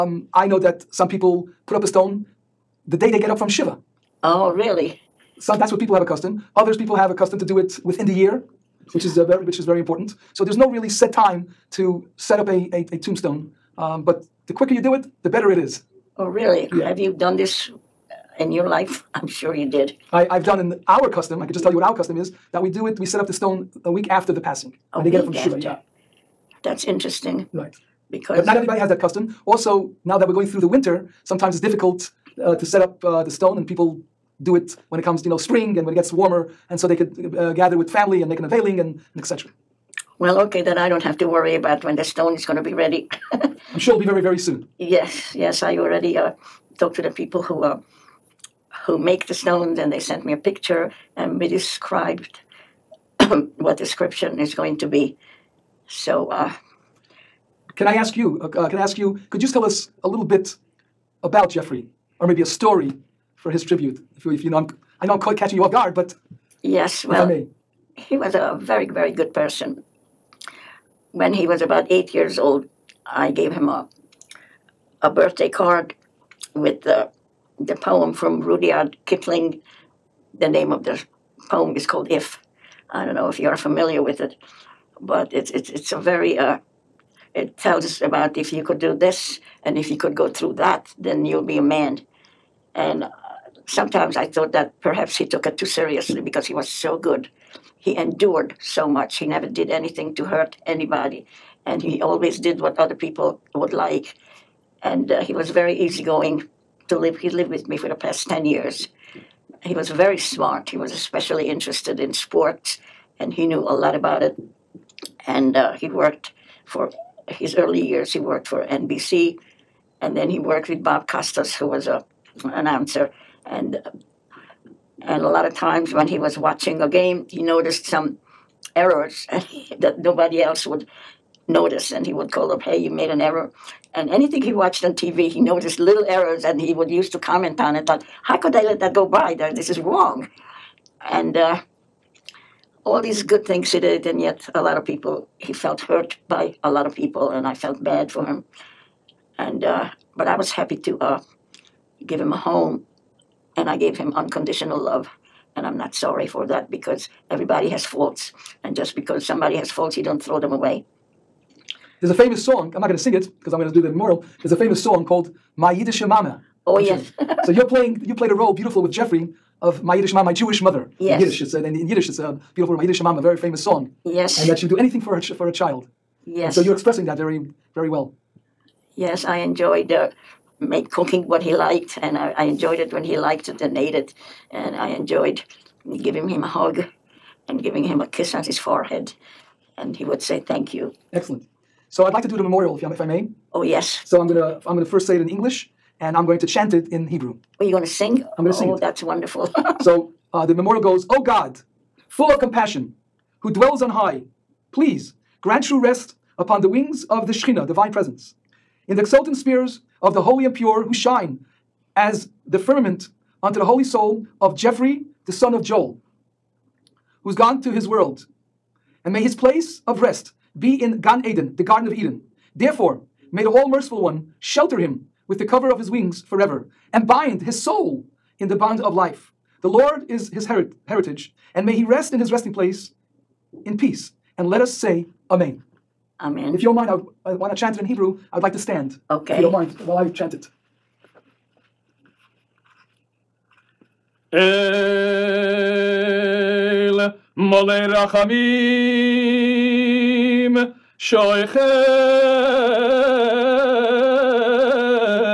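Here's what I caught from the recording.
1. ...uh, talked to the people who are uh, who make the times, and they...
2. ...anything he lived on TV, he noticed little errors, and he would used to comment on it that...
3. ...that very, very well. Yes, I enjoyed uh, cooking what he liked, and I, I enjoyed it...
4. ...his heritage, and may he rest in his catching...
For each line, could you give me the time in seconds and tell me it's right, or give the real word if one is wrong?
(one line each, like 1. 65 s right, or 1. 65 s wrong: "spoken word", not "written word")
1. 46 s wrong: "stones", not "times"
2. 134 s wrong: "watched", not "lived"
3. 177 s right
4. 230 s wrong: "resting", not "catching".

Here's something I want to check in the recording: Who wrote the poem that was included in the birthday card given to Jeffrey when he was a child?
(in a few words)
Rudyard Kipling.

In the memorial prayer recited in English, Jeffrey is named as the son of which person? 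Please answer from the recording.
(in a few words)
Joel.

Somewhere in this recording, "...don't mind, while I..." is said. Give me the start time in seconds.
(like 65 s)
239 s.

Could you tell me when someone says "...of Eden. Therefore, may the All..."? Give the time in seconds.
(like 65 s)
221 s.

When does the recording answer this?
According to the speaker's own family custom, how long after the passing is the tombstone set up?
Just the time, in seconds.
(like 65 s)
23 s.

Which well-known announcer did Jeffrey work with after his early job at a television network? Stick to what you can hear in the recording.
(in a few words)
Bob Costas.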